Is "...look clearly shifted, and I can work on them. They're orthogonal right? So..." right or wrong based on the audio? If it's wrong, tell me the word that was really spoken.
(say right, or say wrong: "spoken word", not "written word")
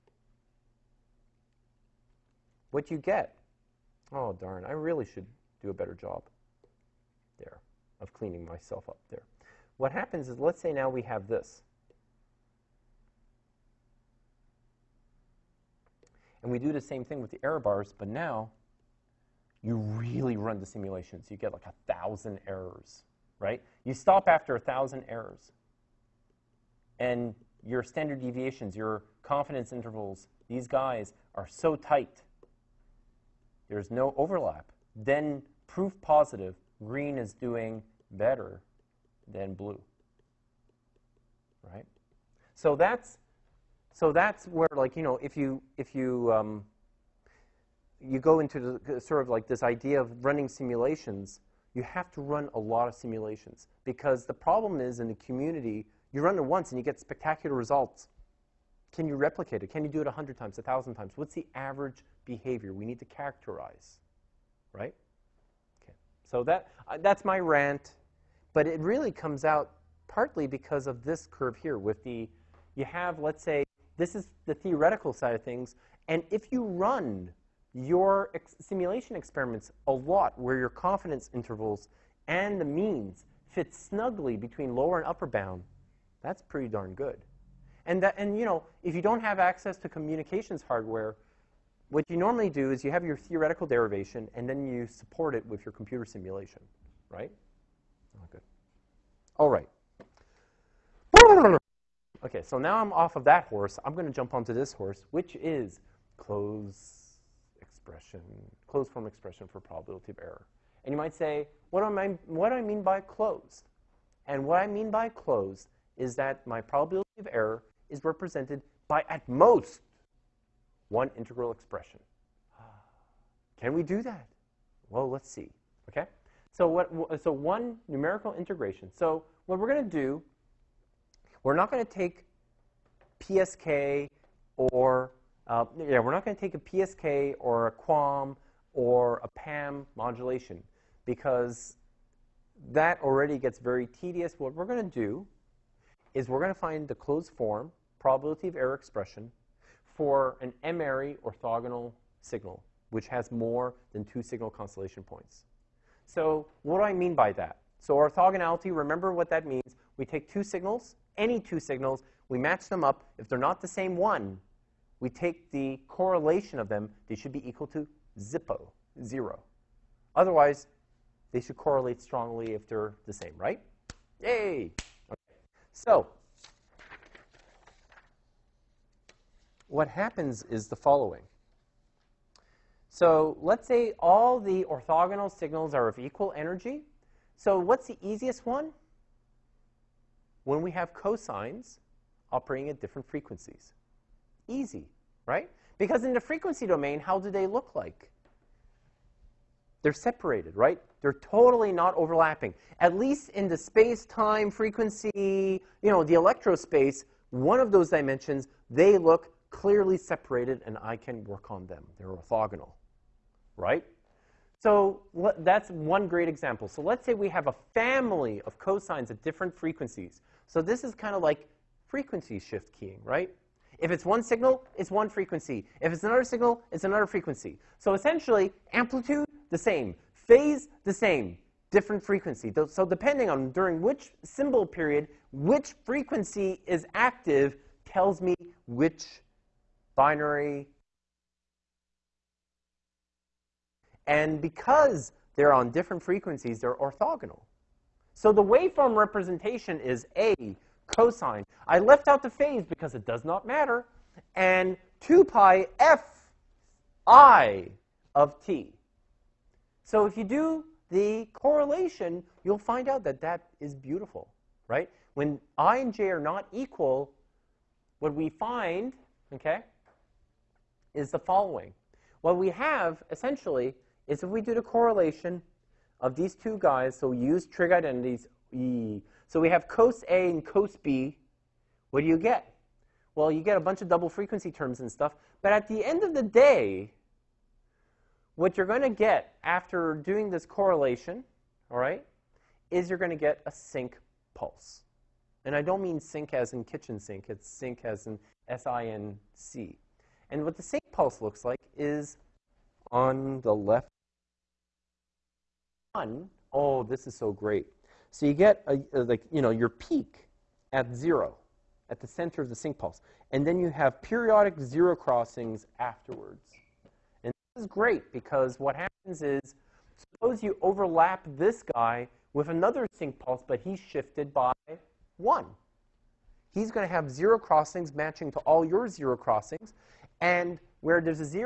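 wrong: "separated", not "shifted".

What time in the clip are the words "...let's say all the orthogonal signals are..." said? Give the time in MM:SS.
03:03.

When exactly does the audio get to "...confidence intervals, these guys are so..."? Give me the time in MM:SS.
00:29.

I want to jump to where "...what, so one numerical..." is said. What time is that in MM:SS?
02:06.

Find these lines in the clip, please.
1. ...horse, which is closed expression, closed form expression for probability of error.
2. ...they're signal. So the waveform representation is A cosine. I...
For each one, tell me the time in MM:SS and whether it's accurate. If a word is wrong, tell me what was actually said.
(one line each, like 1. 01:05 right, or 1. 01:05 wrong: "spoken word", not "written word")
1. 01:44 right
2. 04:06 wrong: "orthogonal", not "signal".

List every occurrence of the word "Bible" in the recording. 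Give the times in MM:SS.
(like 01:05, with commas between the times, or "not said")
not said.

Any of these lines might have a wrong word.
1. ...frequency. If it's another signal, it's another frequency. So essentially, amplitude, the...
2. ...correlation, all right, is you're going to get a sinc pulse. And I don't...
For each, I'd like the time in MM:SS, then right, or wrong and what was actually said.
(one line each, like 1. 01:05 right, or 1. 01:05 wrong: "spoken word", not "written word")
1. 03:45 right
2. 04:50 right.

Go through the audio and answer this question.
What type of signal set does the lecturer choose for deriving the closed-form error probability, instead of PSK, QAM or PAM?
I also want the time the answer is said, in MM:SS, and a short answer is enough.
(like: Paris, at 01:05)
M-ary orthogonal signal, at 02:30.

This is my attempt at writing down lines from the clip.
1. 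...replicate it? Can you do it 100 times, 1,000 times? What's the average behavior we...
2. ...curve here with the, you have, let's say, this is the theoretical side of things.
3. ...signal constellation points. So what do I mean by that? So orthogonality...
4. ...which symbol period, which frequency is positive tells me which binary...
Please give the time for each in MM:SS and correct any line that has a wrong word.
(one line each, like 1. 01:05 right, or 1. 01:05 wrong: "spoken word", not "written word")
1. 00:59 right
2. 01:11 right
3. 02:34 right
4. 03:53 wrong: "active", not "positive".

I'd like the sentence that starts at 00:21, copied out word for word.
You get like a 1,000 errors, right?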